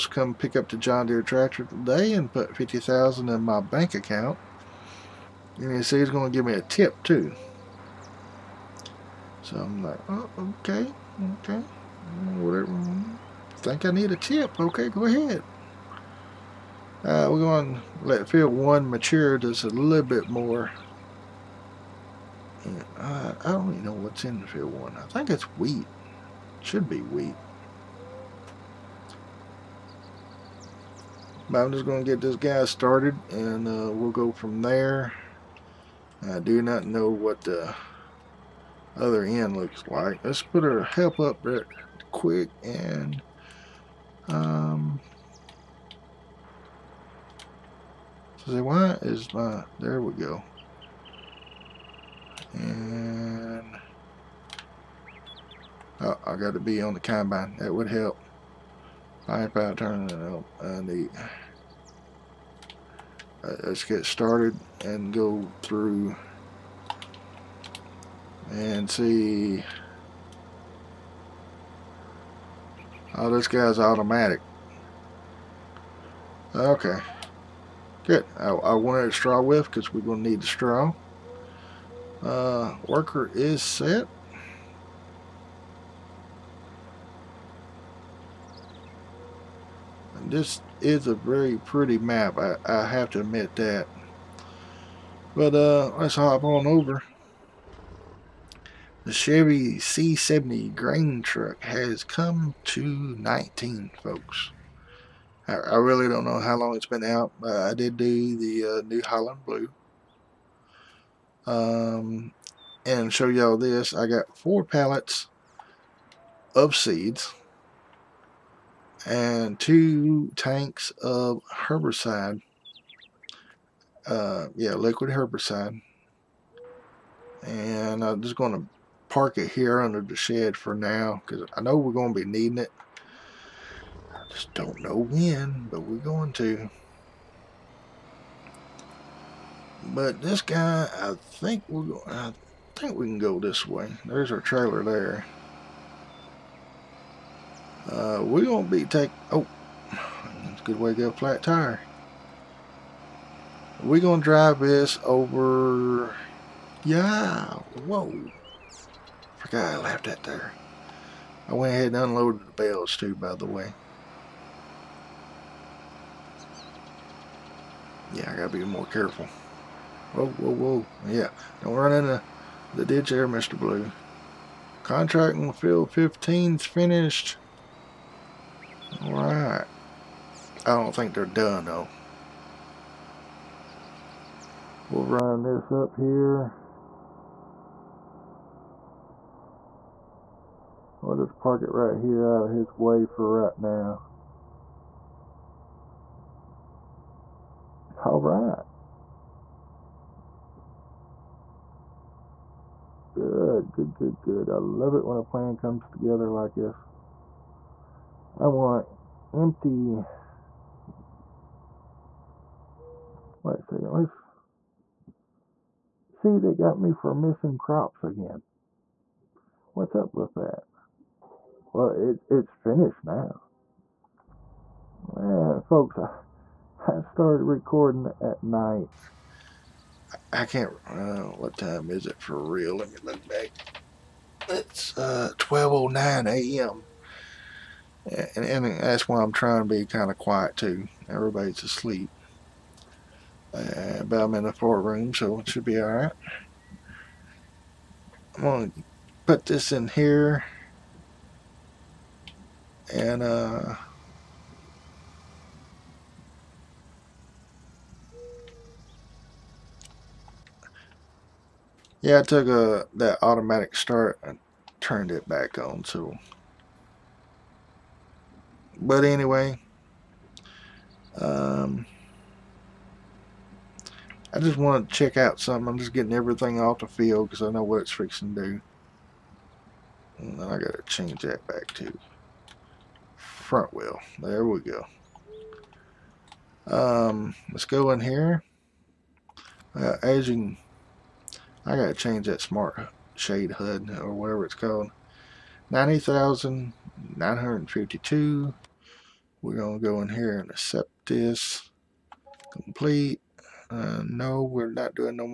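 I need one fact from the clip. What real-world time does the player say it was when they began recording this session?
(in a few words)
12:09 a.m.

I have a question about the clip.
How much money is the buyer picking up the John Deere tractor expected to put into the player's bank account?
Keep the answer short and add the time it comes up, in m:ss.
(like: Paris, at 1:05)
50000, at 0:02.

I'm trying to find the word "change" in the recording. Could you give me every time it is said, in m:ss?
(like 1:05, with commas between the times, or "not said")
4:40, 4:51.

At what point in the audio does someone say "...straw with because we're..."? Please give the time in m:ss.
1:19.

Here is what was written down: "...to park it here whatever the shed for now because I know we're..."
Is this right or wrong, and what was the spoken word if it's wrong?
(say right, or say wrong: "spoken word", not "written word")
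wrong: "under", not "whatever".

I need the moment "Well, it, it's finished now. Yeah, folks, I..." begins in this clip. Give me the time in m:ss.
3:41.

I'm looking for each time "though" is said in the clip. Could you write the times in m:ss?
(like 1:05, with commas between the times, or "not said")
3:01.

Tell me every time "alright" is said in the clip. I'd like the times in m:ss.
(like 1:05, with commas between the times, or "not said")
2:59, 4:05.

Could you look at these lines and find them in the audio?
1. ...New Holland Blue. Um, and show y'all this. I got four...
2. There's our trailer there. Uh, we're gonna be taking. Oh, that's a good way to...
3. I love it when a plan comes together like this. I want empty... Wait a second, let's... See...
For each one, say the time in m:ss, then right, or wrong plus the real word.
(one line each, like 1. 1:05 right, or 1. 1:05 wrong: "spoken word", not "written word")
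1. 1:48 right
2. 2:24 right
3. 3:24 right.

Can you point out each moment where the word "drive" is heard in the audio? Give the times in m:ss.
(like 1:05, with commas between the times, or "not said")
2:34.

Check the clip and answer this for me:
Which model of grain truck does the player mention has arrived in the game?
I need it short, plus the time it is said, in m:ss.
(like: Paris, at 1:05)
Chevy C70, at 1:39.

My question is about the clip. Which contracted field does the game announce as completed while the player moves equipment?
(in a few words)
Field 15.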